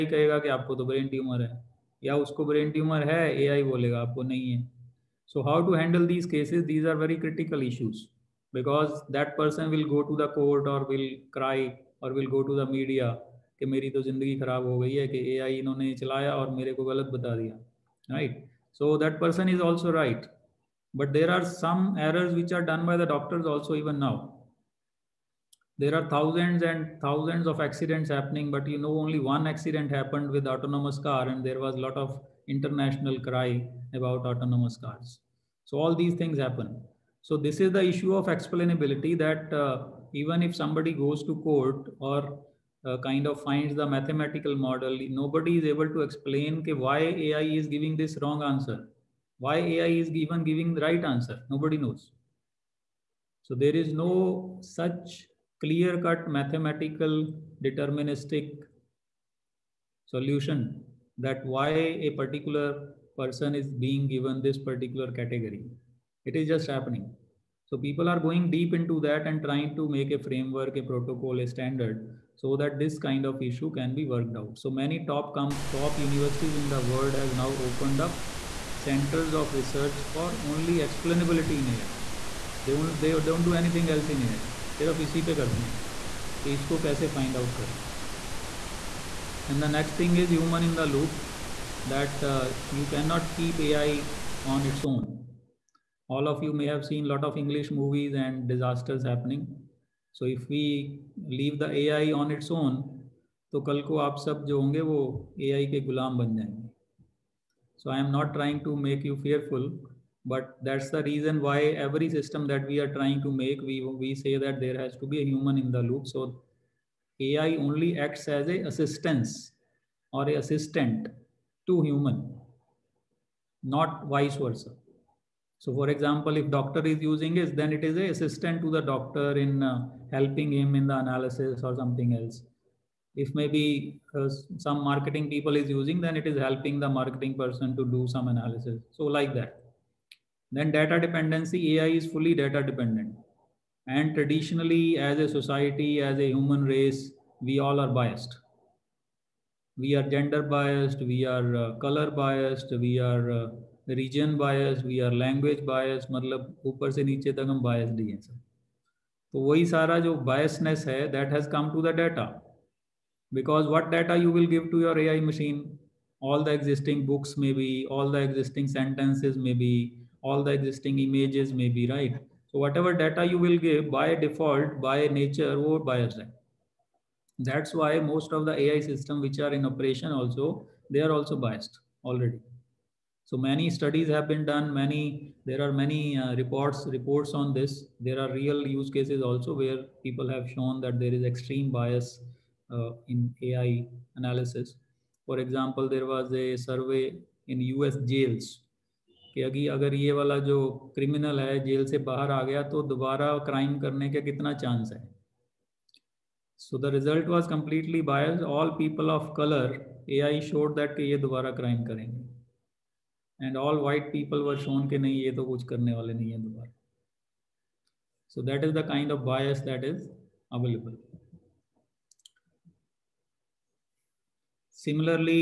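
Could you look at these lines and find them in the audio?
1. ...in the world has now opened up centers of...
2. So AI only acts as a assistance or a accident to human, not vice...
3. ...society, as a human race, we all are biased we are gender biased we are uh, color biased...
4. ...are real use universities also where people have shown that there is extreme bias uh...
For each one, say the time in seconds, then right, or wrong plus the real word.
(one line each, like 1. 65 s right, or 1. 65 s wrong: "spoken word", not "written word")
1. 76 s right
2. 116 s wrong: "assistant", not "accident"
3. 145 s right
4. 188 s wrong: "cases", not "universities".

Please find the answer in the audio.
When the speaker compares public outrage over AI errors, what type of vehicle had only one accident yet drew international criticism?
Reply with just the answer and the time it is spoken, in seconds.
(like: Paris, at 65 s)
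autonomous car, at 30 s.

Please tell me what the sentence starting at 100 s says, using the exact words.
So if we leave the AI on its own, तो कल को आप सब जो होंगे वो AI के गुलाम बन जाएंगे.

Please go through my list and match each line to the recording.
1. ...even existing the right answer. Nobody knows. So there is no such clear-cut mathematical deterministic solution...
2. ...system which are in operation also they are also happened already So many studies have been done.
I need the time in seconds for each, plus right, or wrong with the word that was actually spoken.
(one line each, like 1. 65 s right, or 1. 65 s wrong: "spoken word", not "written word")
1. 50 s wrong: "giving", not "existing"
2. 178 s wrong: "biased", not "happened".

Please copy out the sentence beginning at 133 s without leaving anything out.
If maybe uh, some marketing people is using, then it is helping the marketing person to do some analysis.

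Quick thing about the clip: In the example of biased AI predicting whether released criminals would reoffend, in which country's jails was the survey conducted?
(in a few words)
U.S.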